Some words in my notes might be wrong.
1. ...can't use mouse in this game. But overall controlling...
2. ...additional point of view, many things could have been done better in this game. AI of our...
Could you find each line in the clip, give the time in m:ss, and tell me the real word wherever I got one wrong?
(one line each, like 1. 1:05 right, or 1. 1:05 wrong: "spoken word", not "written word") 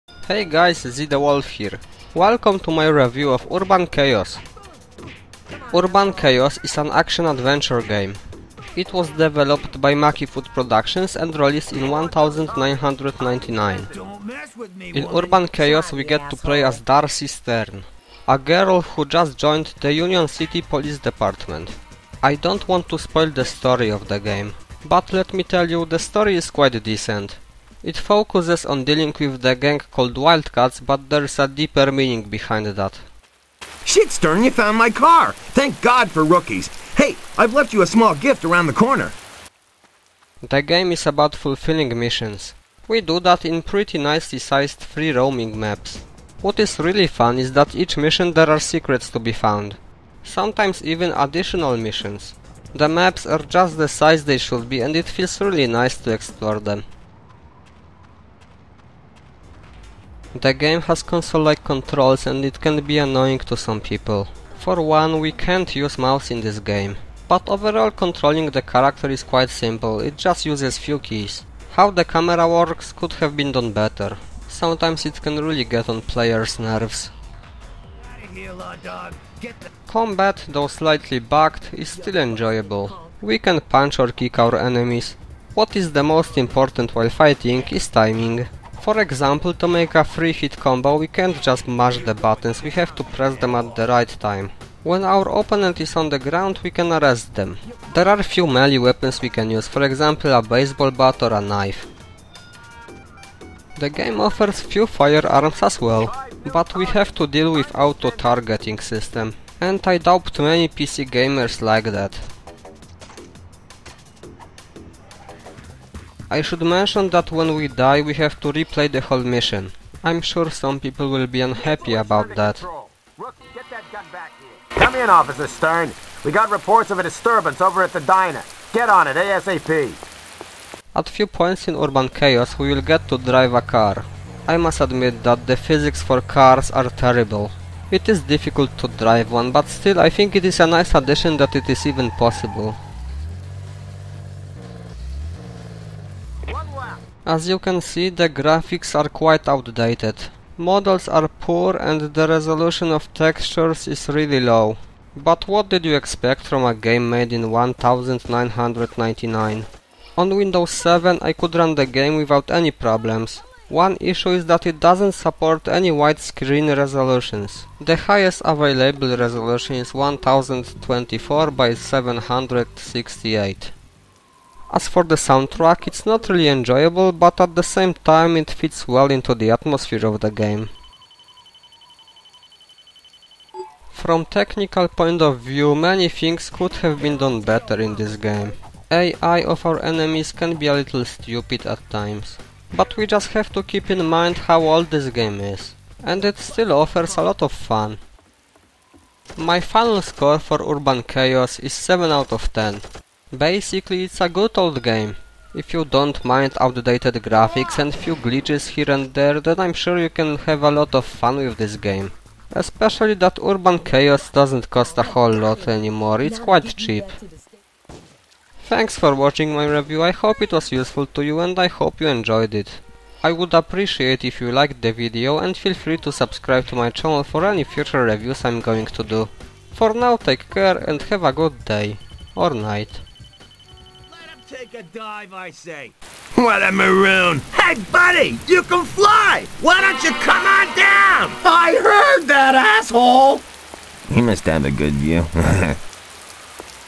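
1. 1:05 right
2. 3:04 wrong: "technical", not "additional".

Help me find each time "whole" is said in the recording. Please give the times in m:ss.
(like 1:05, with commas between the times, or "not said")
1:59, 3:35.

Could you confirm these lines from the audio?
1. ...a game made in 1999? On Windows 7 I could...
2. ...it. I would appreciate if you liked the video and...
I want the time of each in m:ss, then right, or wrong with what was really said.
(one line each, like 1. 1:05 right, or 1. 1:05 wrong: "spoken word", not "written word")
1. 2:36 right
2. 3:42 right.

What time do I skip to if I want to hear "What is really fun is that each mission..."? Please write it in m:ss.
0:46.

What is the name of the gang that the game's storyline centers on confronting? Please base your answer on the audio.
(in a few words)
Wildcats.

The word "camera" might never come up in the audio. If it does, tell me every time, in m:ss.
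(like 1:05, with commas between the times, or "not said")
1:12.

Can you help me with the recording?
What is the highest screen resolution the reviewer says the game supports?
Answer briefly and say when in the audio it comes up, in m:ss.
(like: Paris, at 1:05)
1024 by 768, at 2:49.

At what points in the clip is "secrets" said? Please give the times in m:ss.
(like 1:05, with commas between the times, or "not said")
0:48.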